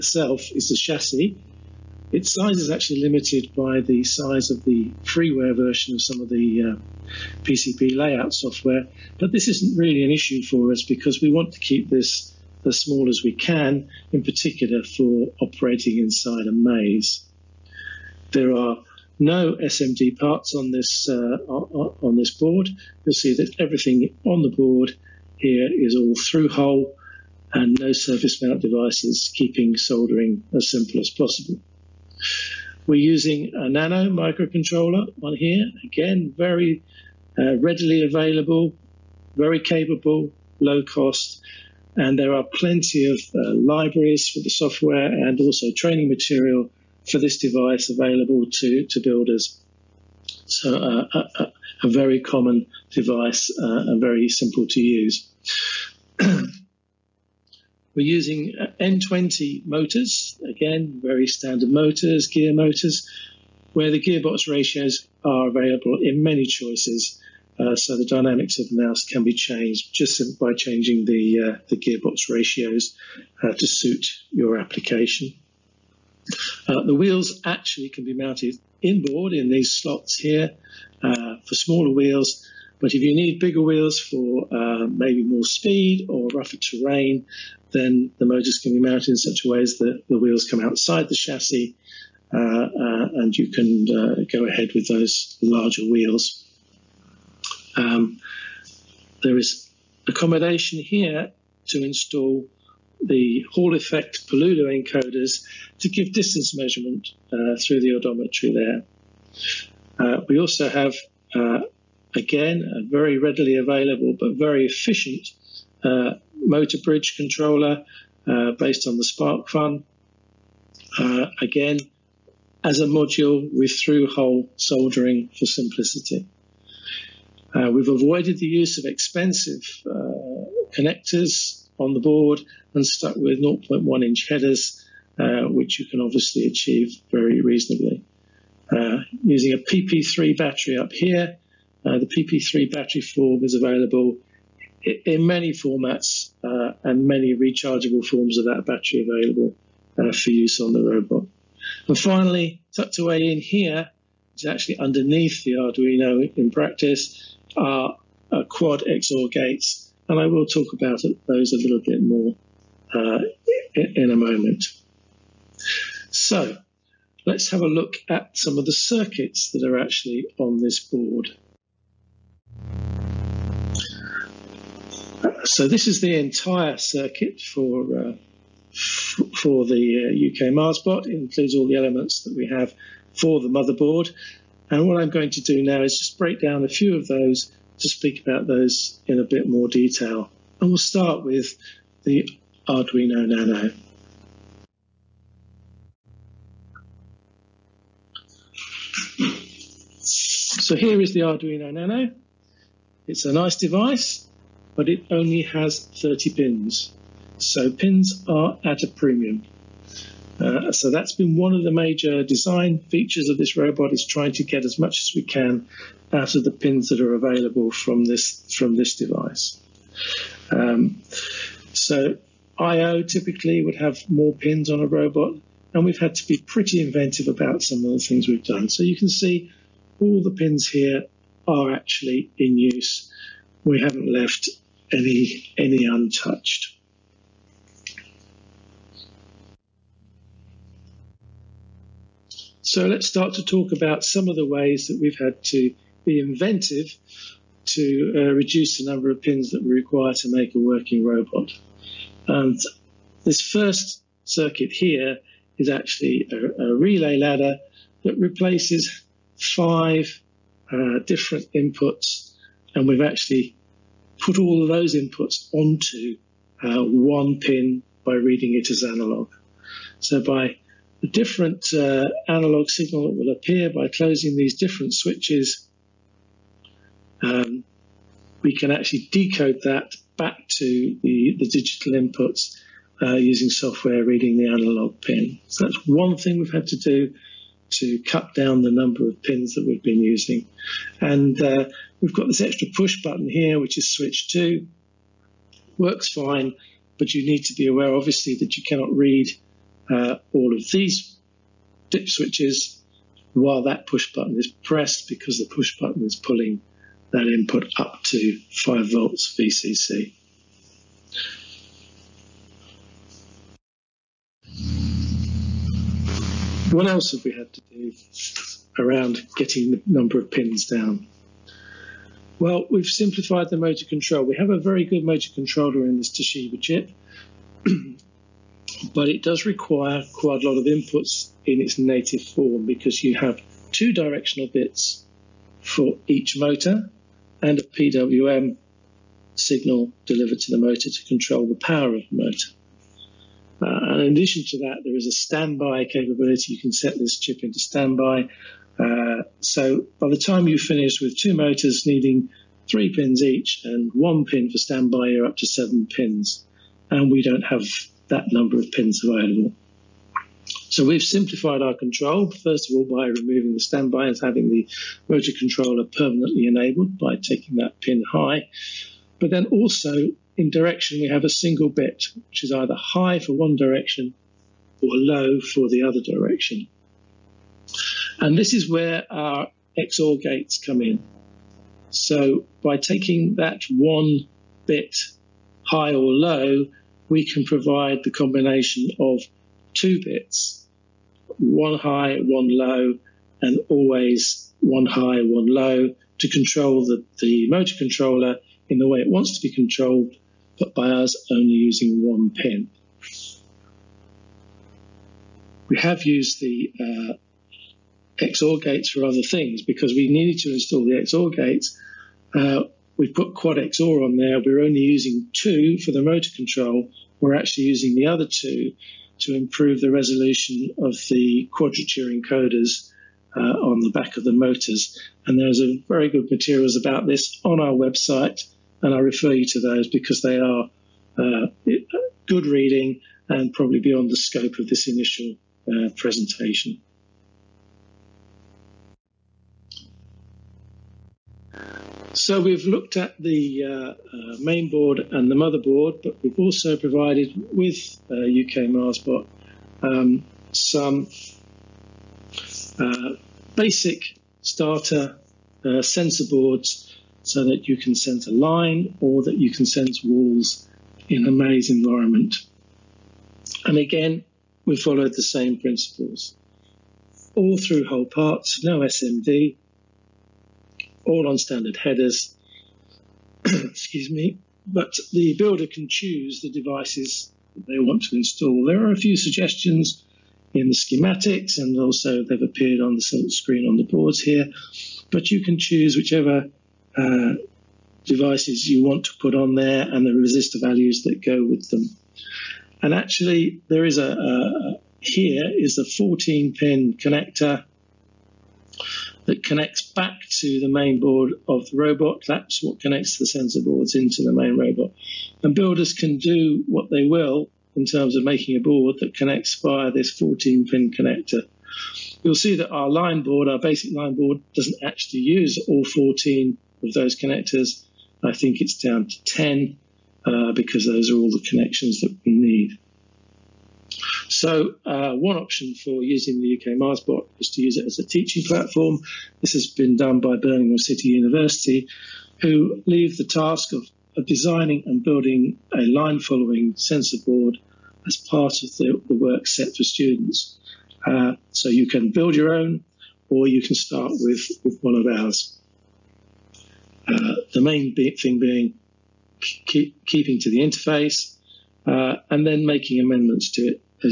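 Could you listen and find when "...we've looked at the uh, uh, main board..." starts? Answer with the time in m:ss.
7:22.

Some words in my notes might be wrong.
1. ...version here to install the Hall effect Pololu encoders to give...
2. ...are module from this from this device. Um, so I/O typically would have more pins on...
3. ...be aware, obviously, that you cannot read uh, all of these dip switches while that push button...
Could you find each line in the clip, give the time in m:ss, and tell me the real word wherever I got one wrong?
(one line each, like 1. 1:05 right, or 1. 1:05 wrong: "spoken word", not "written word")
1. 1:40 wrong: "accommodation", not "version"
2. 3:37 wrong: "available", not "module"
3. 4:57 right.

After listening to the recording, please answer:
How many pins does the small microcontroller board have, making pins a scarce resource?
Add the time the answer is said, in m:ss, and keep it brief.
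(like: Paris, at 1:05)
30, at 3:26.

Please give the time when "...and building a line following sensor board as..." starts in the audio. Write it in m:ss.
8:54.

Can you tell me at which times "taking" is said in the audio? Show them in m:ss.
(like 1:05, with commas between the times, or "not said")
6:07, 6:22.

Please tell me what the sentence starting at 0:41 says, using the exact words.
And there are plenty of uh, libraries for the software and also training material for this device available to, to builders.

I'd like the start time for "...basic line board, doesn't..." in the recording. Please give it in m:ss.
8:33.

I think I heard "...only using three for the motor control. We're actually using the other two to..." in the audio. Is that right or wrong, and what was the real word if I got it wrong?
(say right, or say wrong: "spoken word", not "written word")
wrong: "two", not "three".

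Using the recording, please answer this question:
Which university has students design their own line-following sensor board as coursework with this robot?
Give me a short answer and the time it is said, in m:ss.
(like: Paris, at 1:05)
Birmingham City University, at 8:50.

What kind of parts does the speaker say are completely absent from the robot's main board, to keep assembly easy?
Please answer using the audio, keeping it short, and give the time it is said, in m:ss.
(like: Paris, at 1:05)
SMD parts, at 0:19.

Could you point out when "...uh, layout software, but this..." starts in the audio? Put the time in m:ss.
0:06.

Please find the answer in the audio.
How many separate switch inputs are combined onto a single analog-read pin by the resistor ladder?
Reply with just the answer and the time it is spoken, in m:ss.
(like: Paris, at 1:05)
5, at 4:19.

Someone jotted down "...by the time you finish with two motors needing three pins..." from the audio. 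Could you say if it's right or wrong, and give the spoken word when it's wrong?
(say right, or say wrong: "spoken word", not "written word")
right.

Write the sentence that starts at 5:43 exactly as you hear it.
Uh, and in addition to that, there is a standby capability.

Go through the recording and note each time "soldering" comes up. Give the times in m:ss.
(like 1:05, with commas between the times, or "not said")
0:29, 2:04.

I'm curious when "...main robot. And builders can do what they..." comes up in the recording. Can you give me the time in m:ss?
8:24.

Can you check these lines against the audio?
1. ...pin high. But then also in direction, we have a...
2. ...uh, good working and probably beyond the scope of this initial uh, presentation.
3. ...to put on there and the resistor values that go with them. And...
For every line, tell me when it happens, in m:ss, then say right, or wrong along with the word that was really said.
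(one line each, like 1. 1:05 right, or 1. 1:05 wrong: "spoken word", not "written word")
1. 6:07 right
2. 7:11 wrong: "reading", not "working"
3. 8:09 right.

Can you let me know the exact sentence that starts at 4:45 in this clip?
So that's one thing we've had to do to cut down the number of pins that we've been using.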